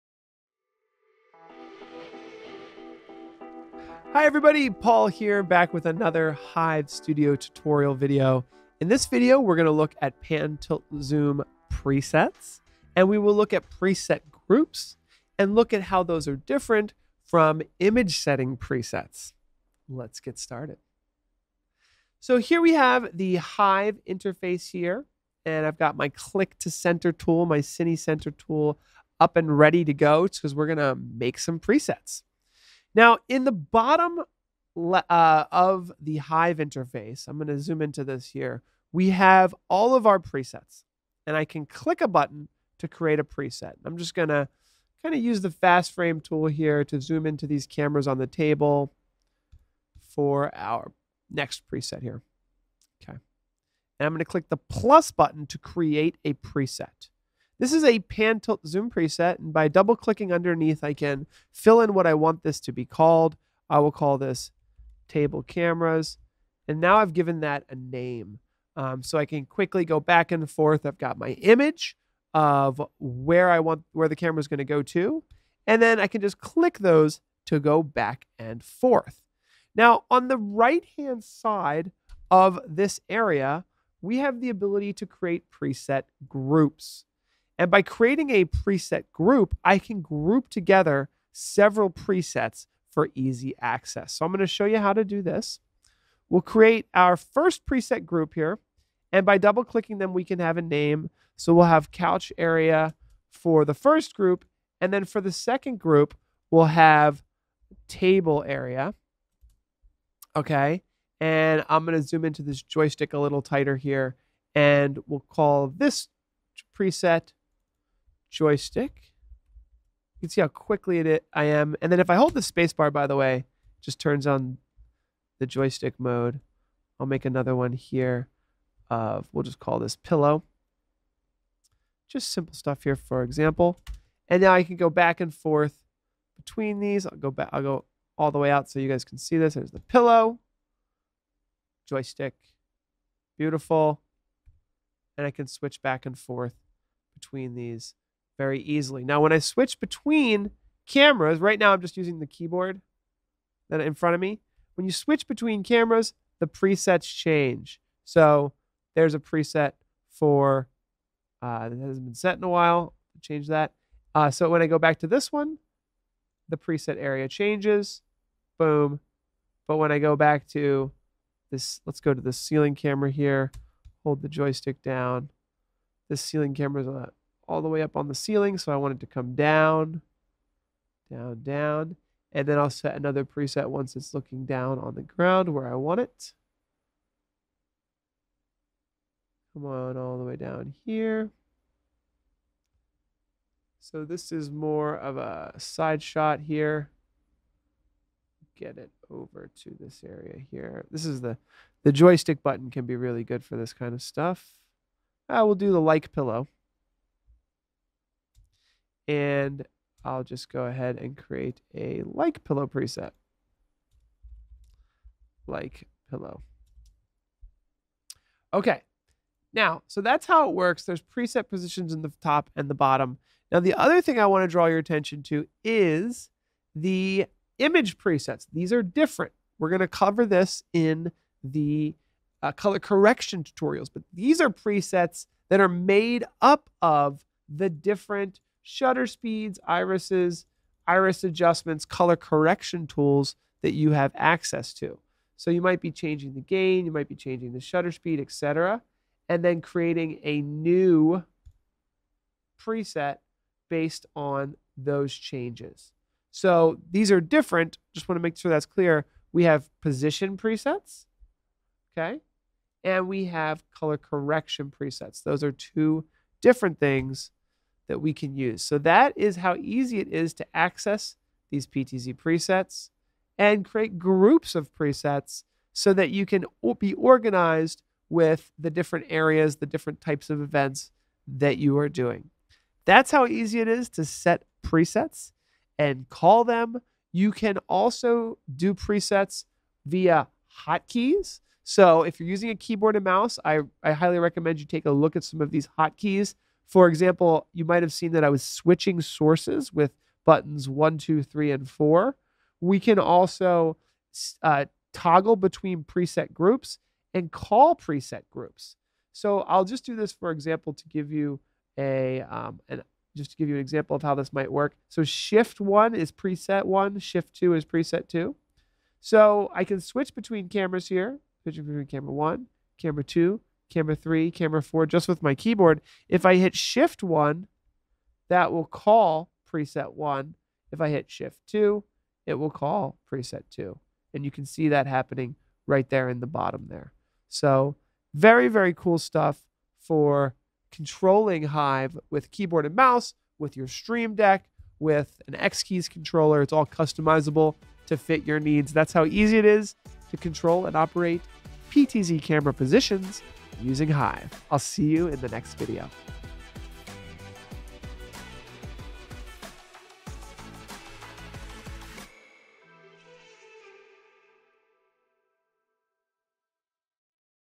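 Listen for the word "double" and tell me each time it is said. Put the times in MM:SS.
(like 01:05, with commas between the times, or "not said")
00:59, 01:39.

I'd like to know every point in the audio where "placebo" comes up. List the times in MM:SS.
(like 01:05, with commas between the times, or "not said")
not said.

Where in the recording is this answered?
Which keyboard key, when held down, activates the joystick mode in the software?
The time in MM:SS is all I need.
02:02.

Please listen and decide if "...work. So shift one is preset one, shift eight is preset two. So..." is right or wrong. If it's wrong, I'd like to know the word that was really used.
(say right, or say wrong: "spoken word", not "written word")
wrong: "two", not "eight".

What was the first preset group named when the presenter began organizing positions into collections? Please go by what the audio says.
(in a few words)
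couch area.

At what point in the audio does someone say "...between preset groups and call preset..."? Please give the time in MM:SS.
05:05.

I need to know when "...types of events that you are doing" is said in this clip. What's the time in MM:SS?
04:40.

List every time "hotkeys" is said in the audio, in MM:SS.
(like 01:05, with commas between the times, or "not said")
04:50, 04:55.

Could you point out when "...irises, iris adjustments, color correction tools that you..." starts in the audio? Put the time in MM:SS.
03:59.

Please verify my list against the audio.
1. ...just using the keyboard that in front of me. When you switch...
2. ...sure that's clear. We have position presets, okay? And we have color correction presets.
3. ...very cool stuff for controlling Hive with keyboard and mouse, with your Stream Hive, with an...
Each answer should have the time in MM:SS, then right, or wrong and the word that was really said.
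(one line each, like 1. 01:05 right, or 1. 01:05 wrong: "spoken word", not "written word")
1. 02:31 right
2. 04:18 right
3. 05:38 wrong: "Deck", not "Hive".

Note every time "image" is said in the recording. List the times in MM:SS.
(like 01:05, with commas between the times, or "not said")
00:17, 01:11, 03:47.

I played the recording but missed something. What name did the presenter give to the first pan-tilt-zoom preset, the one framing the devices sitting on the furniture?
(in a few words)
table cameras.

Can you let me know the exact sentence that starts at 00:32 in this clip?
Now, in the bottom uh, of the Hive interface, I'm going to zoom into this here, we have all of our presets.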